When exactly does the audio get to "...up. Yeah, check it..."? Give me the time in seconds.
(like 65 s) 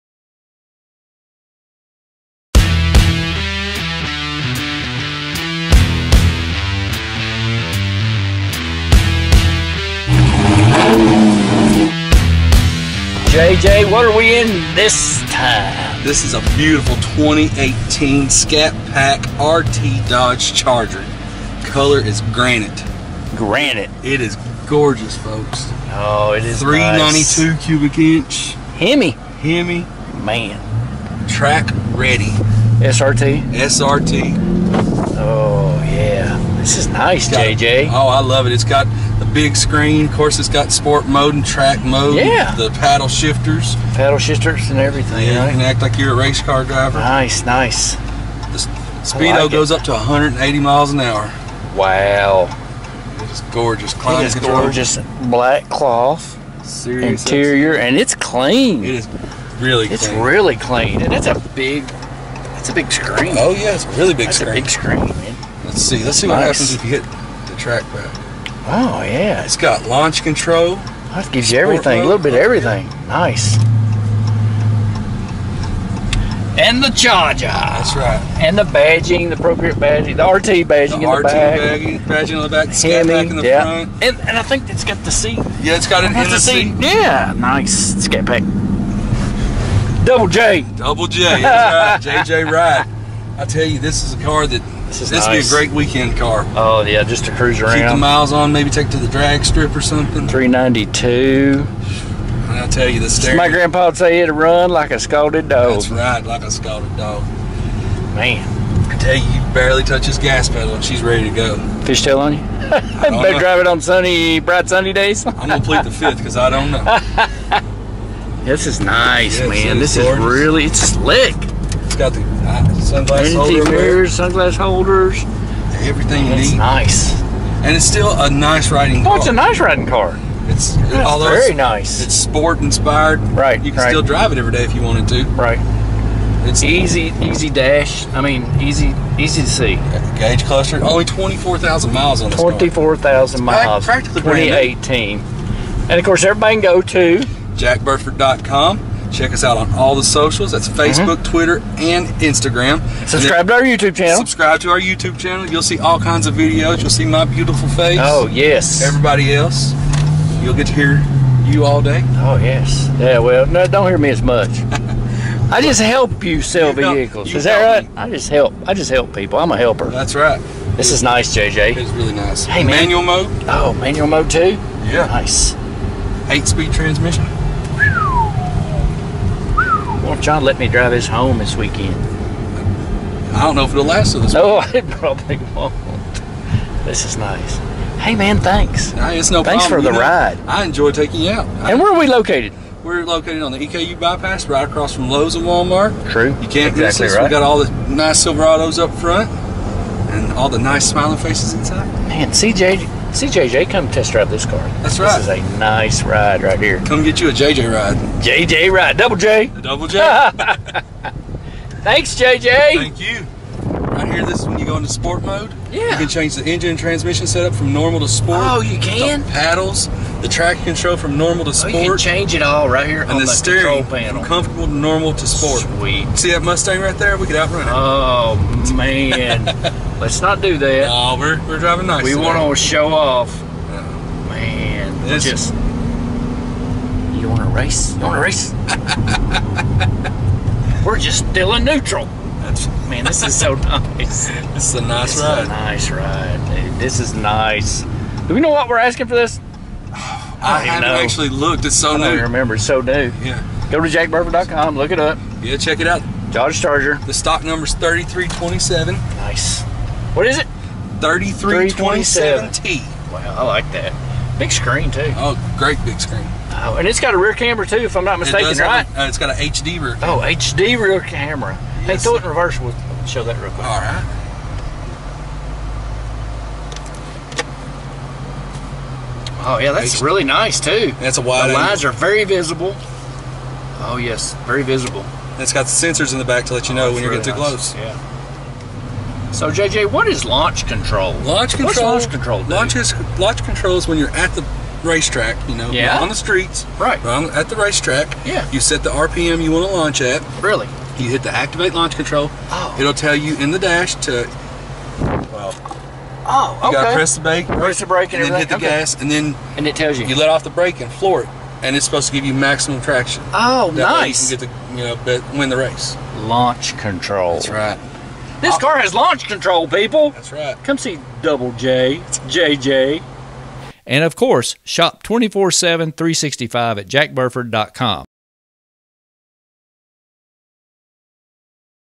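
254 s.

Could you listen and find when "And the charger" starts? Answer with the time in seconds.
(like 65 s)
76 s.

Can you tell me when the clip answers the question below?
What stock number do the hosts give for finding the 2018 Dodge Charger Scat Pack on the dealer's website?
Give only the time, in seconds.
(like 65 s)
260 s.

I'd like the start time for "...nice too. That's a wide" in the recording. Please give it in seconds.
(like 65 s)
280 s.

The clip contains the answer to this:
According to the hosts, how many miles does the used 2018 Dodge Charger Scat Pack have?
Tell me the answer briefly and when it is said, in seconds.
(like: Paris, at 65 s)
24,000, at 140 s.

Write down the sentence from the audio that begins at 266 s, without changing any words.
Oh, and it's got a rear camera too, if I'm not mistaken, it right?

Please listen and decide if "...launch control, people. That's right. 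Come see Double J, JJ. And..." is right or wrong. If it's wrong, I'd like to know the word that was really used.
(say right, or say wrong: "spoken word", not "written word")
right.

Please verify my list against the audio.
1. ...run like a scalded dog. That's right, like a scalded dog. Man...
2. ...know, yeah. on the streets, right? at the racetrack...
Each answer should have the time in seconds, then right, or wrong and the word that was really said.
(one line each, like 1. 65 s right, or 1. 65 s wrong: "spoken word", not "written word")
1. 104 s right
2. 295 s right.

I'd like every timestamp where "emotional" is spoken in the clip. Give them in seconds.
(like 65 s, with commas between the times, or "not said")
not said.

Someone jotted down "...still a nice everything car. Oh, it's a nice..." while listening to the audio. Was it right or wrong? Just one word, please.
wrong.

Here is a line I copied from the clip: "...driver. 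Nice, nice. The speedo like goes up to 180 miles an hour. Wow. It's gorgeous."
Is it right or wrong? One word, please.
right.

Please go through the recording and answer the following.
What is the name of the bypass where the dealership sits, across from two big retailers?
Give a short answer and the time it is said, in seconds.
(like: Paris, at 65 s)
EKU bypass, at 193 s.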